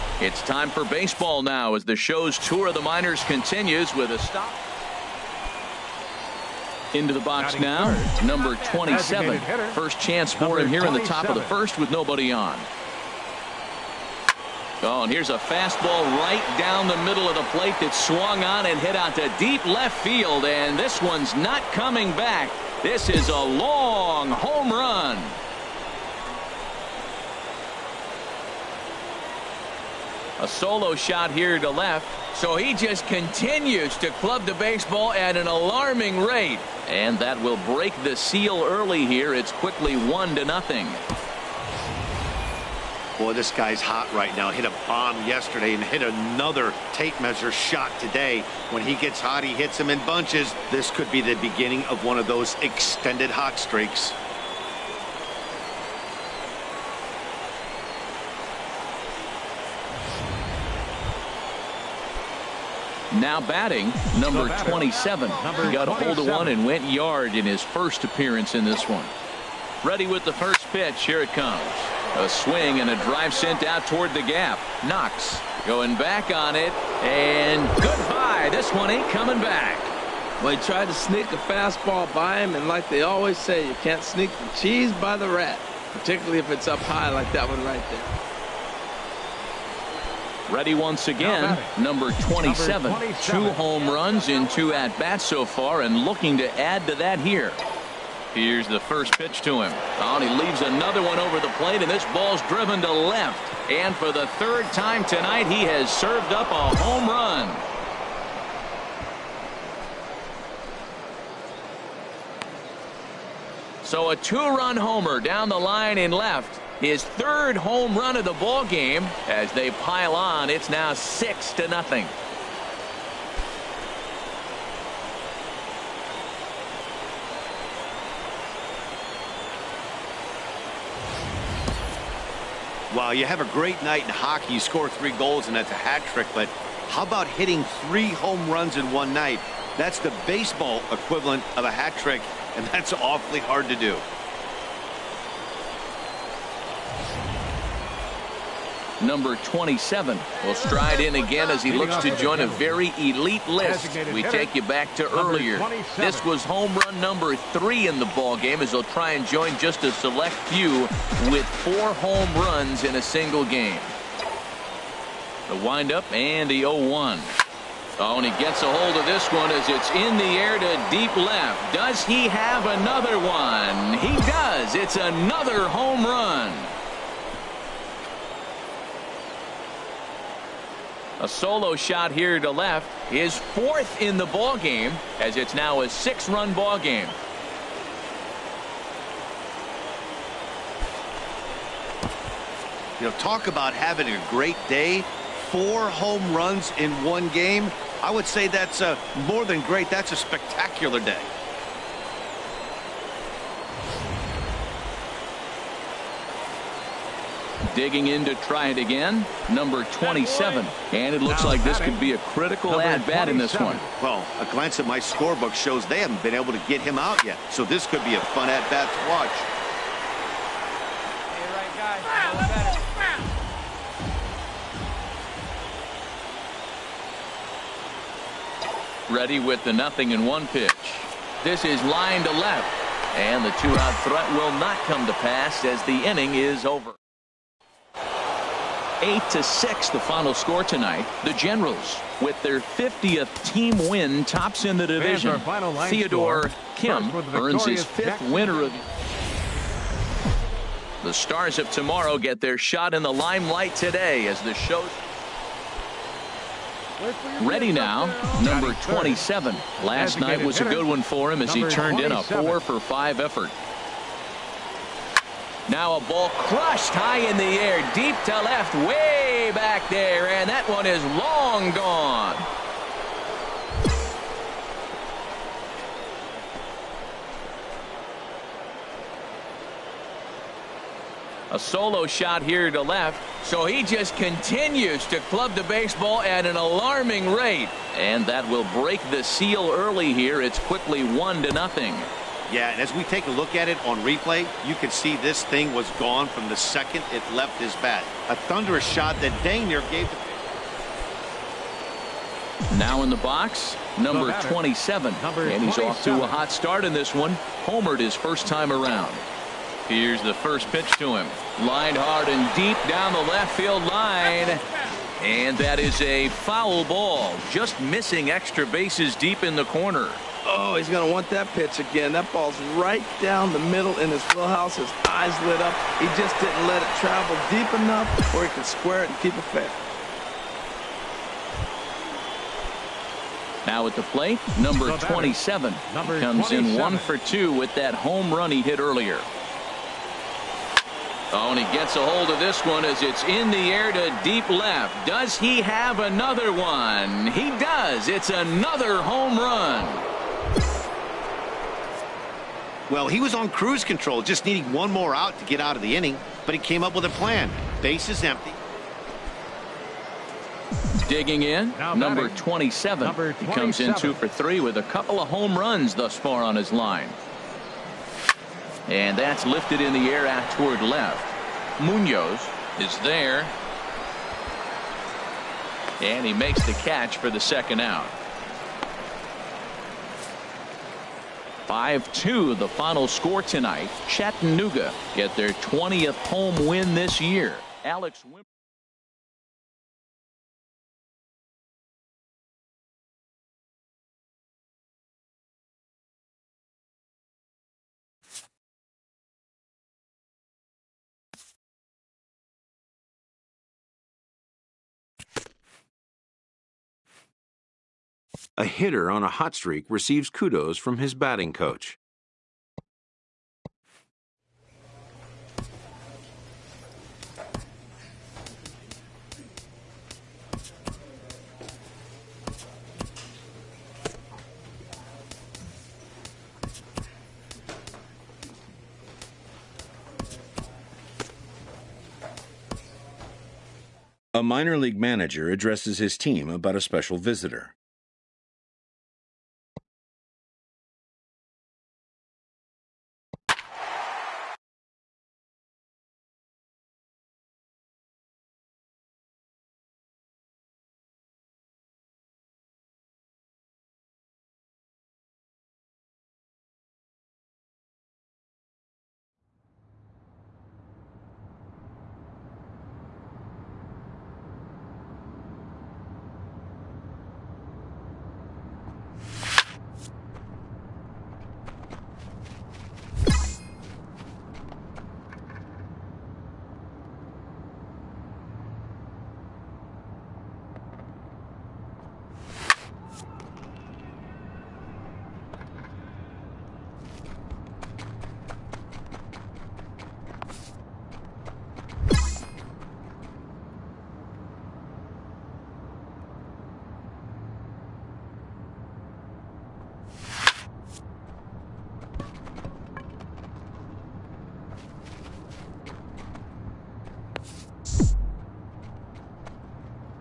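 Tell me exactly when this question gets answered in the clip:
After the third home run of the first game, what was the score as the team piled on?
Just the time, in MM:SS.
02:00.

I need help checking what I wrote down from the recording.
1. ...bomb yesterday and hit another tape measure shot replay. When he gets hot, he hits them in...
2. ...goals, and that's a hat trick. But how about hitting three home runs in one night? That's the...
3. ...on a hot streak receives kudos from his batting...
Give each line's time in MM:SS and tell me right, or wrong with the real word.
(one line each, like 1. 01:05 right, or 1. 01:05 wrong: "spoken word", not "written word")
1. 00:44 wrong: "today", not "replay"
2. 02:15 right
3. 06:49 right.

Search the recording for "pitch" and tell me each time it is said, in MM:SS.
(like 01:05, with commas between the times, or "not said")
01:10, 01:39, 03:50, 05:10, 05:21.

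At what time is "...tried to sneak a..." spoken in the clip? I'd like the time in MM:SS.
01:20.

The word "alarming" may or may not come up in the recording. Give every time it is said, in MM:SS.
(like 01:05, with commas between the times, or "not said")
00:35, 04:46.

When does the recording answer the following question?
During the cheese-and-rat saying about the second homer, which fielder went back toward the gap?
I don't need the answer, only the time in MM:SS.
01:14.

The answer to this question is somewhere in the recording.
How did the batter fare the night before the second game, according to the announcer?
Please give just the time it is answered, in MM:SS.
04:22.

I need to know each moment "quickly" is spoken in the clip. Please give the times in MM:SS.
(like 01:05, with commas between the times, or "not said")
00:39, 04:50.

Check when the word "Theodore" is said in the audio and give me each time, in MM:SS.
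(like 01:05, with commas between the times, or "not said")
04:05.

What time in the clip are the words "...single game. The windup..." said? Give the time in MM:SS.
02:43.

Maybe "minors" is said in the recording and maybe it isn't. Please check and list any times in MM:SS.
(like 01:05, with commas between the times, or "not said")
00:02, 07:14.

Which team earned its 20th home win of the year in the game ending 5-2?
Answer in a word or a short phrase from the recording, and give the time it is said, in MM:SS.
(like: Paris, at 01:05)
Chattanooga, at 06:24.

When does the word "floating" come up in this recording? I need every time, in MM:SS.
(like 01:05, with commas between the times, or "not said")
not said.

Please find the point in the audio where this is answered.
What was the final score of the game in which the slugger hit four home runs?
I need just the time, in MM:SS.
03:59.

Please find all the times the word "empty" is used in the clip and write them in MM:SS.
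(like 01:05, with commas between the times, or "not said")
05:58.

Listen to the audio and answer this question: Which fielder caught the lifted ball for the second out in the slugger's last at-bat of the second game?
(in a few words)
Munoz.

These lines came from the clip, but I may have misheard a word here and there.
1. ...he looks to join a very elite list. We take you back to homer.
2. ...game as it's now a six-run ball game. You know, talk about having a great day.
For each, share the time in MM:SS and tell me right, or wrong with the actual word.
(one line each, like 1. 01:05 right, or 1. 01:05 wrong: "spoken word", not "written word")
1. 02:31 wrong: "earlier", not "homer"
2. 03:04 right.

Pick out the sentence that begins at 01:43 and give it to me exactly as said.
And for the third time tonight, he has served up a home run.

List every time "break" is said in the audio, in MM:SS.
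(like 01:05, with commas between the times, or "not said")
00:37, 04:48.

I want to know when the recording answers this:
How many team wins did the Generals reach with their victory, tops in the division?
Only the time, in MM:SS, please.
04:02.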